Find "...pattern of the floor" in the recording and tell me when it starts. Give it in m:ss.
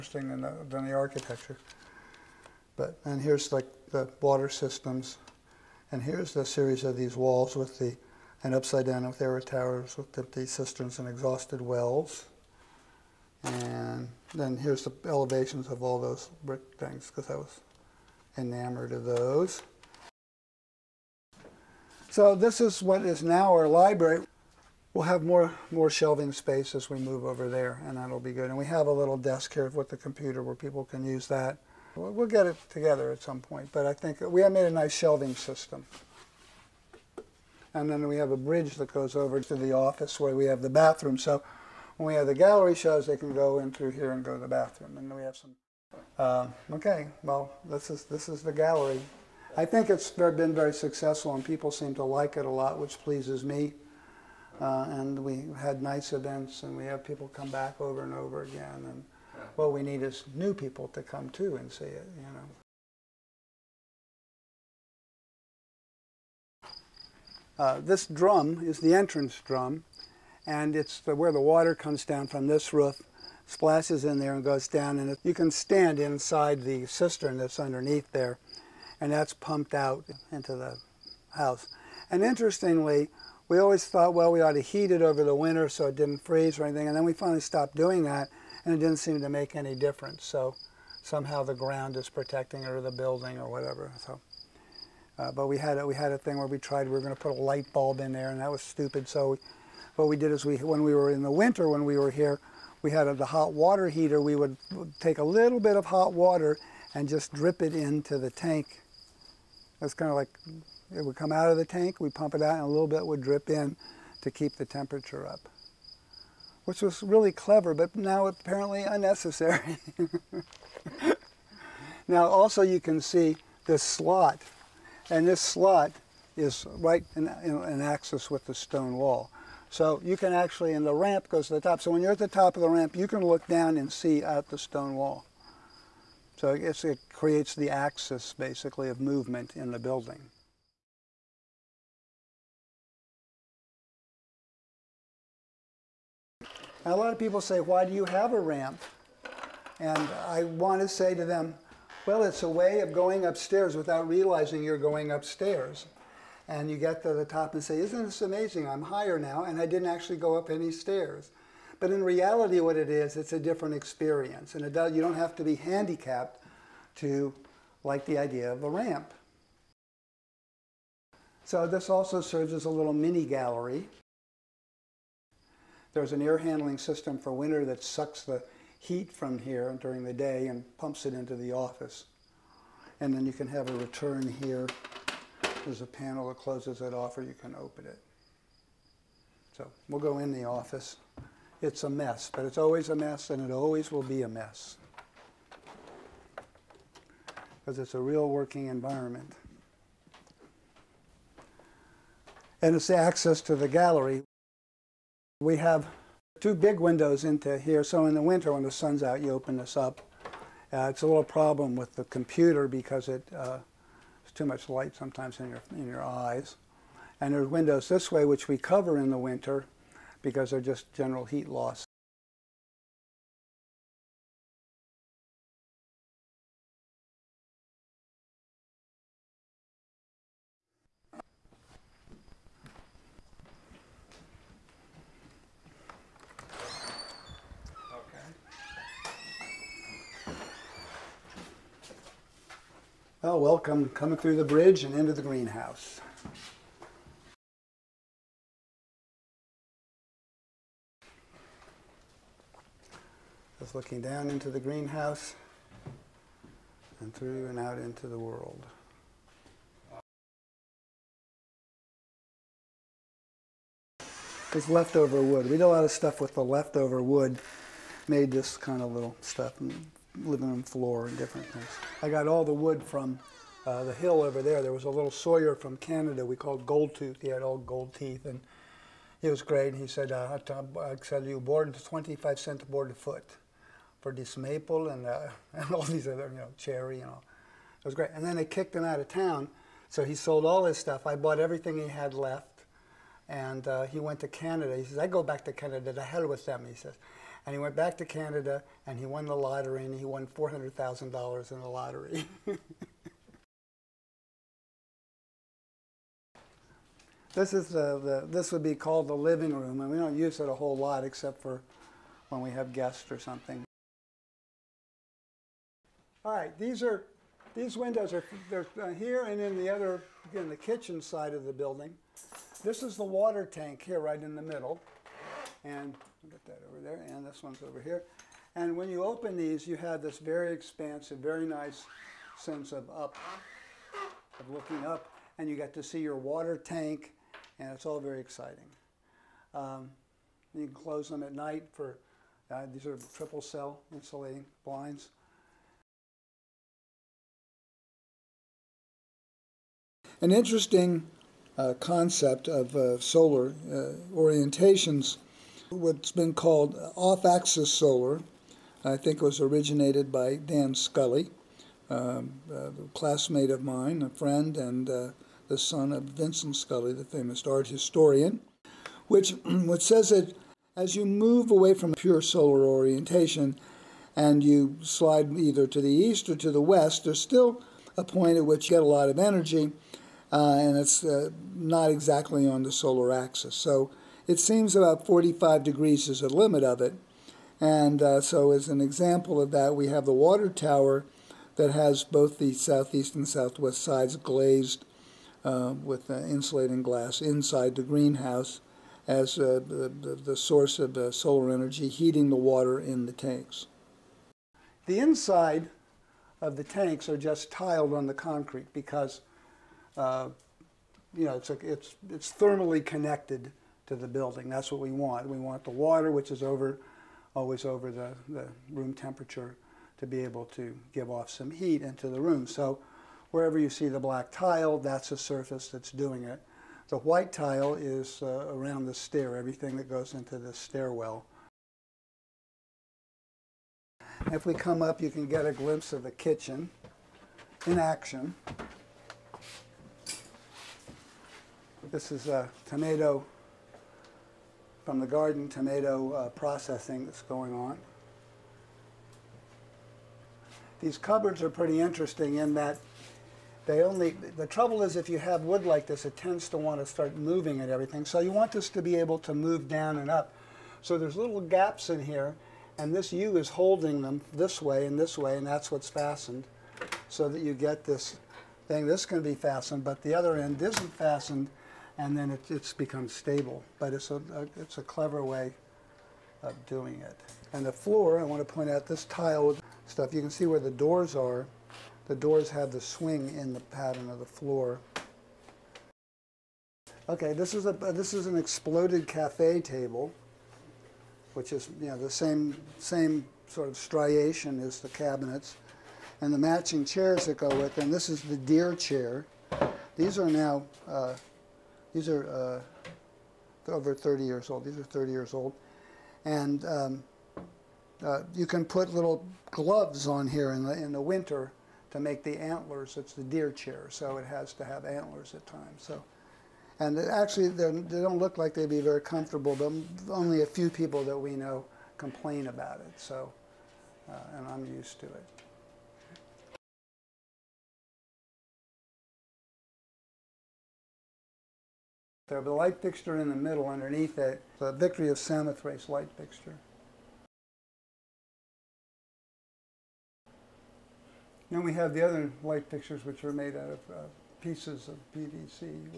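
8:03.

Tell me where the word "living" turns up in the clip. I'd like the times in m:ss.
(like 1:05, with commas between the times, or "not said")
4:30, 5:09.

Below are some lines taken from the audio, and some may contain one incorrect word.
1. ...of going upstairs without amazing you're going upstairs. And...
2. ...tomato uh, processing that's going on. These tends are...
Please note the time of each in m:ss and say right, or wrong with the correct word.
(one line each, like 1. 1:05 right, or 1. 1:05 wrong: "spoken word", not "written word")
1. 2:32 wrong: "realizing", not "amazing"
2. 7:25 wrong: "cupboards", not "tends".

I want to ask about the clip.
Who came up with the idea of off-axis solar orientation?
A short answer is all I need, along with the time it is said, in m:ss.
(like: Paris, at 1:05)
Dan Scully, at 6:00.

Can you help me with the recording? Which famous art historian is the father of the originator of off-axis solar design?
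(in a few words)
Vincent Scully.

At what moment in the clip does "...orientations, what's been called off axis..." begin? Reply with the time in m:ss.
5:54.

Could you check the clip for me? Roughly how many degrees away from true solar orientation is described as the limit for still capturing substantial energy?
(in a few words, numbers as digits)
45 degrees.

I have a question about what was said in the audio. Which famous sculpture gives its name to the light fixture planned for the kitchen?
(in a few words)
Victory of Samothrace.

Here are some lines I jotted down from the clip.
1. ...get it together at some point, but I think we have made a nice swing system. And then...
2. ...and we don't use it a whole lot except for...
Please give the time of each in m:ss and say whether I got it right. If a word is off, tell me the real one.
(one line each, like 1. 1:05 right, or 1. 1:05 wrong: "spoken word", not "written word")
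1. 0:32 wrong: "shelving", not "swing"
2. 5:09 right.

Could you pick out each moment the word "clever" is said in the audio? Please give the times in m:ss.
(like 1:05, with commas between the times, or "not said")
1:57, 7:54.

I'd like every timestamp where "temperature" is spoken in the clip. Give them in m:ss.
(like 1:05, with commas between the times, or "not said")
1:54, 6:58.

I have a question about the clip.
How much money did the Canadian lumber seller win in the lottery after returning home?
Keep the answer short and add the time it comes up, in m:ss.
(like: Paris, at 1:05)
$400,000, at 5:00.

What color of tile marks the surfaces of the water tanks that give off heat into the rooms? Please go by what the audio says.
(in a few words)
Black.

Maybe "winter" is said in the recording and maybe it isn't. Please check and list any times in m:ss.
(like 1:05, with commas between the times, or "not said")
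1:25, 1:41, 2:57, 3:28, 3:39, 8:31.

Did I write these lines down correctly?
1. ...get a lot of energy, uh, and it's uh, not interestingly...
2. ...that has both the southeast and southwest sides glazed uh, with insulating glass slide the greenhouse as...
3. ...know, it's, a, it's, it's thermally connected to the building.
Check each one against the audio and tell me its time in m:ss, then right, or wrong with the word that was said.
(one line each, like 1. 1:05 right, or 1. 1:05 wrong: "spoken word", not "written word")
1. 6:18 wrong: "exactly", not "interestingly"
2. 6:31 wrong: "inside", not "slide"
3. 6:51 right.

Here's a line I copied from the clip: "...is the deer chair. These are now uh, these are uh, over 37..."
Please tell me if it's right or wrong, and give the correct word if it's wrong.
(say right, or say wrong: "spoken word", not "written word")
wrong: "30", not "37".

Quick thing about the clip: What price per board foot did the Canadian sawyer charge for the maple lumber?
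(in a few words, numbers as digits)
25 cents.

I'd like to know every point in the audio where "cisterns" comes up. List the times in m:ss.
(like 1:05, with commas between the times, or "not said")
0:10, 1:16.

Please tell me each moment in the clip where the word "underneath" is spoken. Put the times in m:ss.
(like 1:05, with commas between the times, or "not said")
1:17, 8:53.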